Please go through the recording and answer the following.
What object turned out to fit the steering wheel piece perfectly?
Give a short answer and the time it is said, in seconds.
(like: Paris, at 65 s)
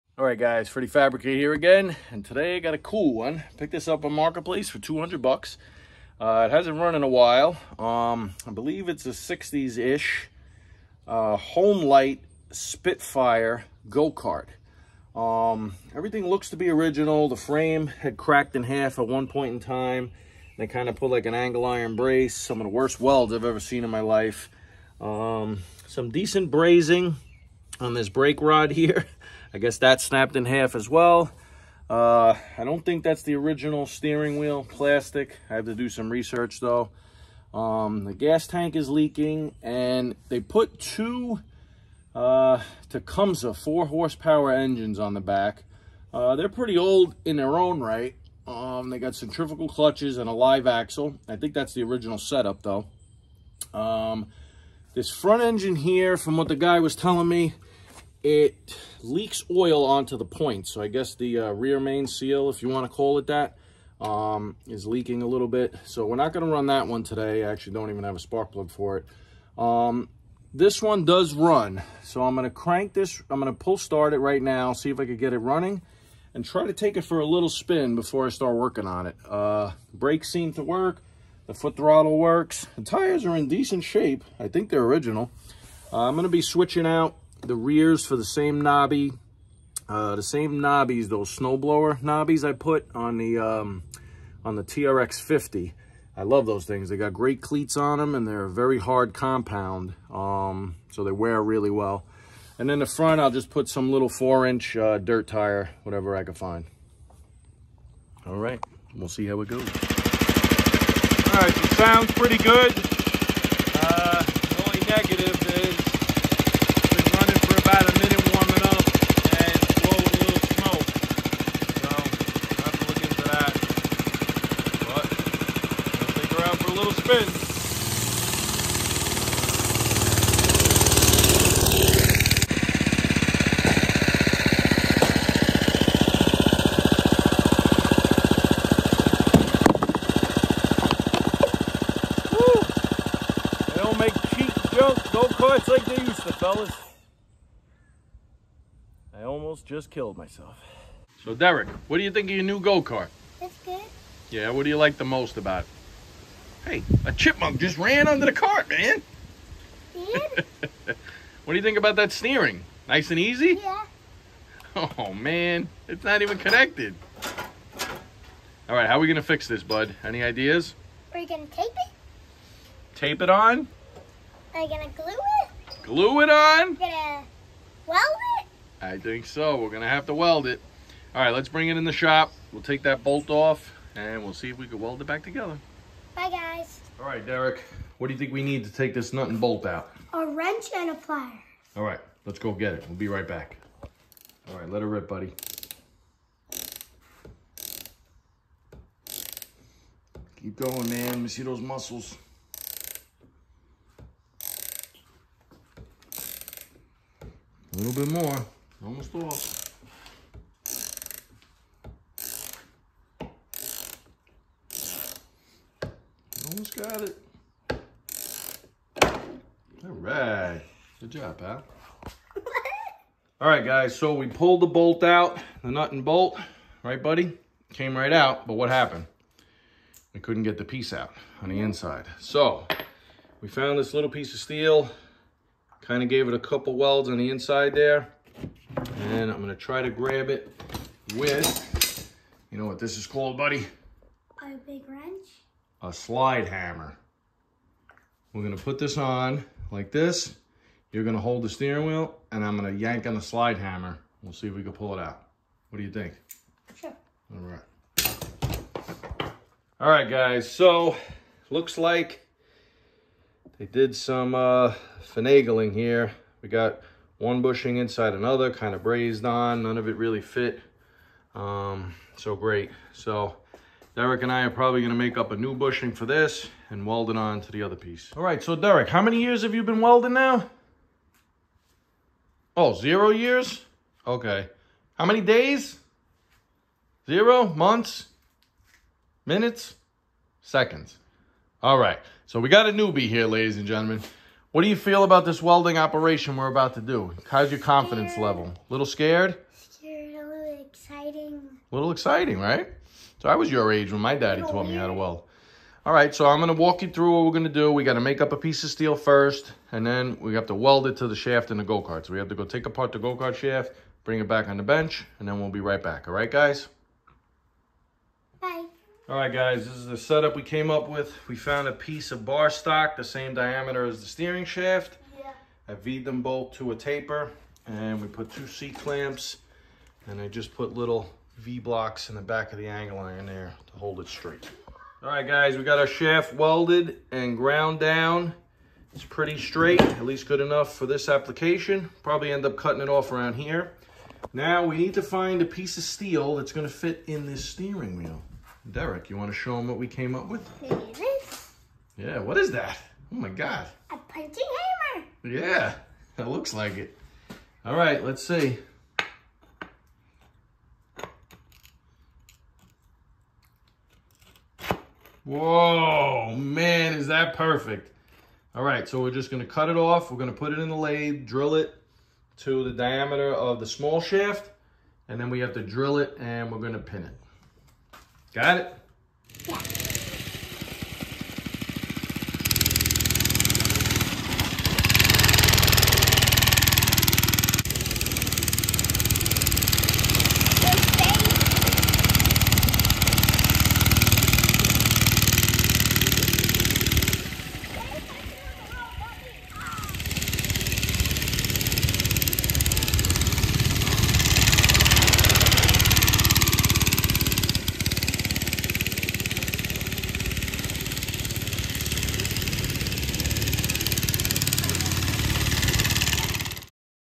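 A punching hammer, at 353 s.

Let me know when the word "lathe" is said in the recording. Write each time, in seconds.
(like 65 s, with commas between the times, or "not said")
370 s.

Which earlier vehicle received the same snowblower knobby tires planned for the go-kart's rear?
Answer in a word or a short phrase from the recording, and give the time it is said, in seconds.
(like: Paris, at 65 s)
TRX 50, at 94 s.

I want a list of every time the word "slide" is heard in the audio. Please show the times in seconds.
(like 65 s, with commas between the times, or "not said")
245 s, 253 s.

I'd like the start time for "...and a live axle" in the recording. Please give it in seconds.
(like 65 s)
50 s.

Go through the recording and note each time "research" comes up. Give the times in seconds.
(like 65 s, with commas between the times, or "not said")
36 s.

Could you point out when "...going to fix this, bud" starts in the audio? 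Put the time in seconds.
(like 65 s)
169 s.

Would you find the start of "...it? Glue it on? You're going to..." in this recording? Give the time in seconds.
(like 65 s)
175 s.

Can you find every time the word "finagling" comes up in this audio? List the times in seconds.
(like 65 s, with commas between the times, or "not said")
265 s.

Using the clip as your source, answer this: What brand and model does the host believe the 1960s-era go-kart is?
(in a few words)
Homelite Spitfire.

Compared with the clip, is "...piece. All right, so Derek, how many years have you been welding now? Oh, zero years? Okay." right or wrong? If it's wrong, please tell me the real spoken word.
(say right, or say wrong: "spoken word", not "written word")
right.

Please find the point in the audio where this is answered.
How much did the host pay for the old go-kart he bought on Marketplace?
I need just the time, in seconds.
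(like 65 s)
4 s.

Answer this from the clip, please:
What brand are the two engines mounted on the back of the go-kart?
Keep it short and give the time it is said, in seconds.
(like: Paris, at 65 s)
Tecumseh, at 42 s.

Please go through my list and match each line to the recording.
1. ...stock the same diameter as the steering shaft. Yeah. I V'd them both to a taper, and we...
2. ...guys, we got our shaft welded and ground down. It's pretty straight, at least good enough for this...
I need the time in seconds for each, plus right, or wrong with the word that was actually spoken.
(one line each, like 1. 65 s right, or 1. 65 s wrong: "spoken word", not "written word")
1. 322 s right
2. 335 s right.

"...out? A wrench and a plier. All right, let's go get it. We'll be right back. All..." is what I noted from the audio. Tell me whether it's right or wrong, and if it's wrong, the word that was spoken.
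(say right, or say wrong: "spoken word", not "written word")
right.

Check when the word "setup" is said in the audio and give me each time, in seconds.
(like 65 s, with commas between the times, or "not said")
52 s, 319 s.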